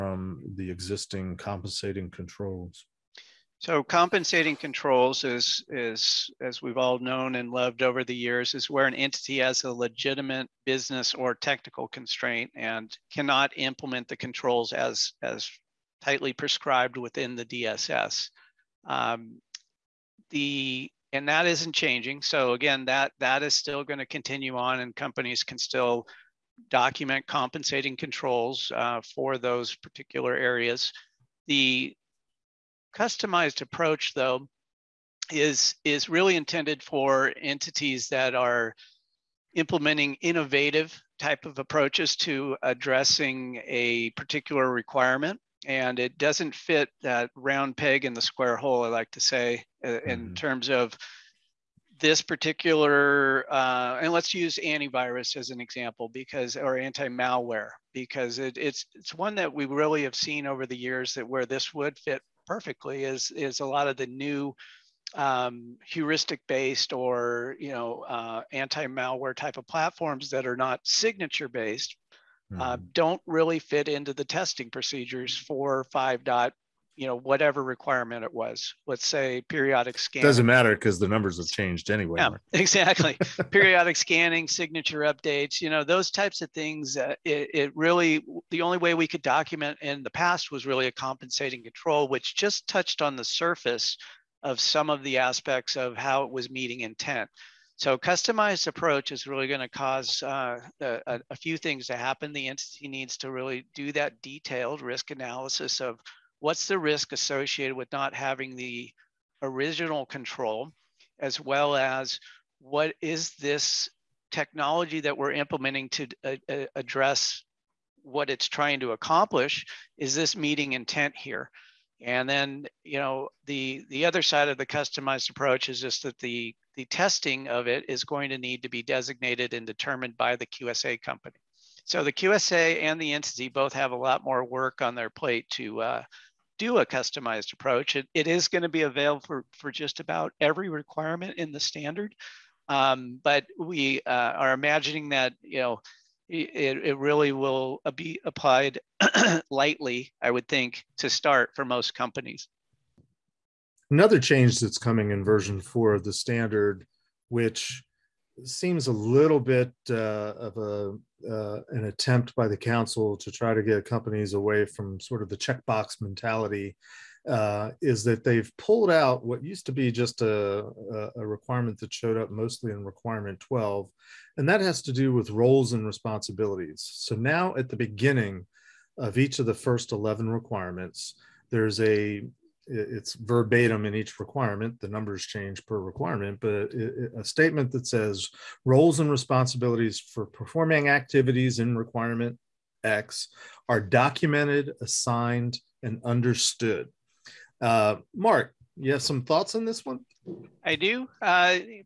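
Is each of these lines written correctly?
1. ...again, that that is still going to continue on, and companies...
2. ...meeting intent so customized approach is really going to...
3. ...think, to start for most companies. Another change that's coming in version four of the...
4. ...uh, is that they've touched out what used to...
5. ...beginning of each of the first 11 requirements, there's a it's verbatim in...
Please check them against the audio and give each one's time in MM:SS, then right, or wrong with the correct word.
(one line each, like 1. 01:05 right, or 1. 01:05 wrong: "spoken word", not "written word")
1. 00:22 right
2. 01:36 right
3. 02:30 right
4. 02:47 wrong: "pulled", not "touched"
5. 02:57 right.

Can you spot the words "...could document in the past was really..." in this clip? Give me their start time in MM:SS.
01:29.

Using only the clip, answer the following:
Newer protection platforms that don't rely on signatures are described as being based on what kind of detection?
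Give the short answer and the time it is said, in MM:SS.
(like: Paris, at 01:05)
Heuristic, at 01:05.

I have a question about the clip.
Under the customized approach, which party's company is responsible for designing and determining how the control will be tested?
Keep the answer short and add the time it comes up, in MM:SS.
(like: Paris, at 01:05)
QSA company, at 02:10.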